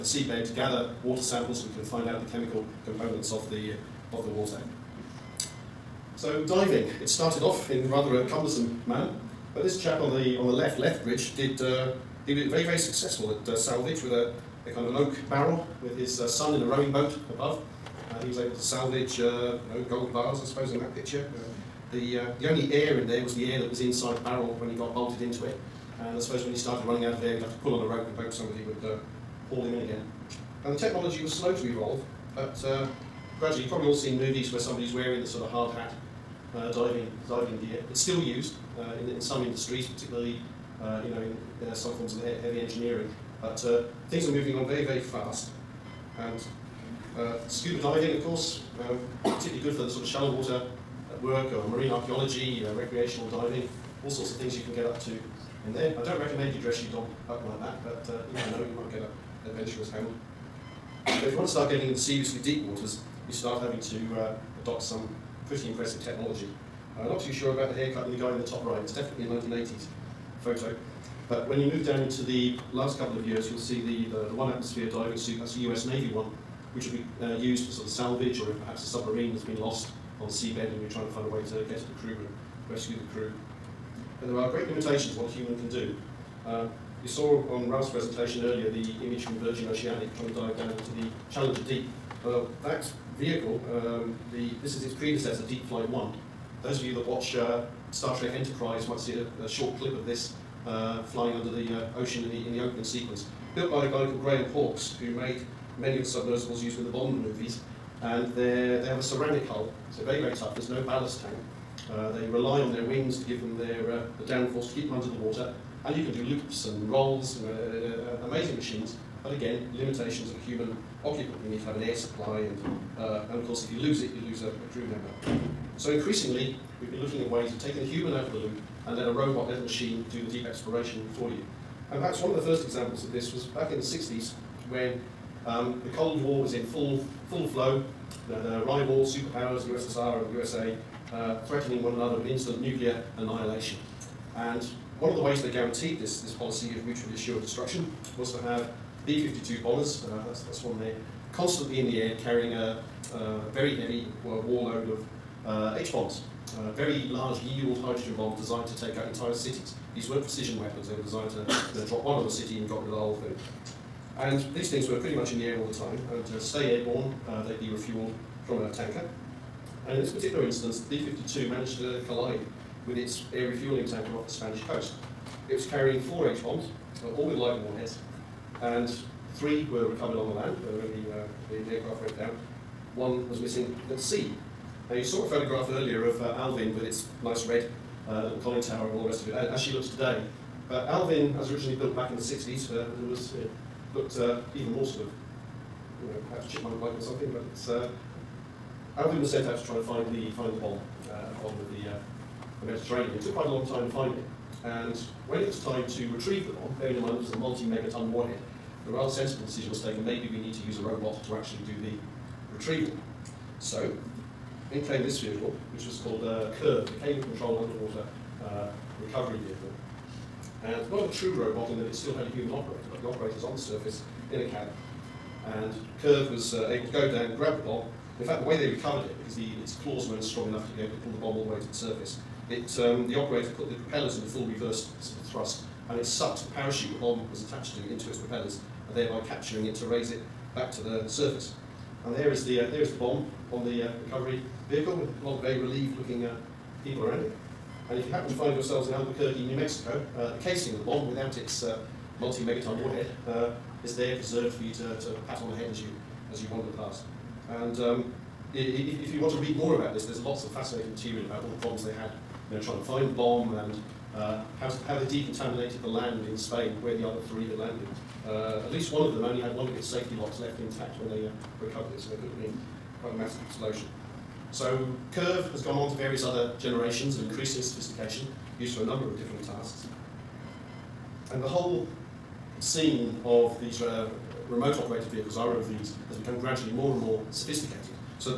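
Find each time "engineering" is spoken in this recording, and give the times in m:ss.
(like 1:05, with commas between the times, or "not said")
0:42.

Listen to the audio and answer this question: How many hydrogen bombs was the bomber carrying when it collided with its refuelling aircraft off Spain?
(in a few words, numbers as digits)
4.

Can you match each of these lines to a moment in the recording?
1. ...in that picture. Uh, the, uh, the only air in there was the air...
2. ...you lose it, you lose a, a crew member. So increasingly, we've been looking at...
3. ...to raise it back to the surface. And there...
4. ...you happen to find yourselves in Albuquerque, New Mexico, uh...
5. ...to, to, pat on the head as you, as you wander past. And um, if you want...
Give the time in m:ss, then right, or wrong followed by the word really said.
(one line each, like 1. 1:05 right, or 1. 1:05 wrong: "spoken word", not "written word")
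1. 0:20 right
2. 2:03 right
3. 3:59 right
4. 4:08 right
5. 4:14 right.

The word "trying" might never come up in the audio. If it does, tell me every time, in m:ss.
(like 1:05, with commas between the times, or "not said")
1:20, 1:30, 4:22.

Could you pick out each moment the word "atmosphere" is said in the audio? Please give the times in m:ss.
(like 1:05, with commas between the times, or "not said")
1:14.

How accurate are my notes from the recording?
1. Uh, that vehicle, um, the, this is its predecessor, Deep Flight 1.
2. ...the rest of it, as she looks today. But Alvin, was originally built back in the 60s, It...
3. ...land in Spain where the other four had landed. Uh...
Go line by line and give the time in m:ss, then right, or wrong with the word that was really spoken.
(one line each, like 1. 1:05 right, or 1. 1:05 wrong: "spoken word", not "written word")
1. 1:32 right
2. 3:09 right
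3. 4:25 wrong: "three", not "four".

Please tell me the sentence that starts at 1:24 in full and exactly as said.
And there are great limitations what a human can do.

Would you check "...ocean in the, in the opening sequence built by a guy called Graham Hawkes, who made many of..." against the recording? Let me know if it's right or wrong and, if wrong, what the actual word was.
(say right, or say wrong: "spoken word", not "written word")
right.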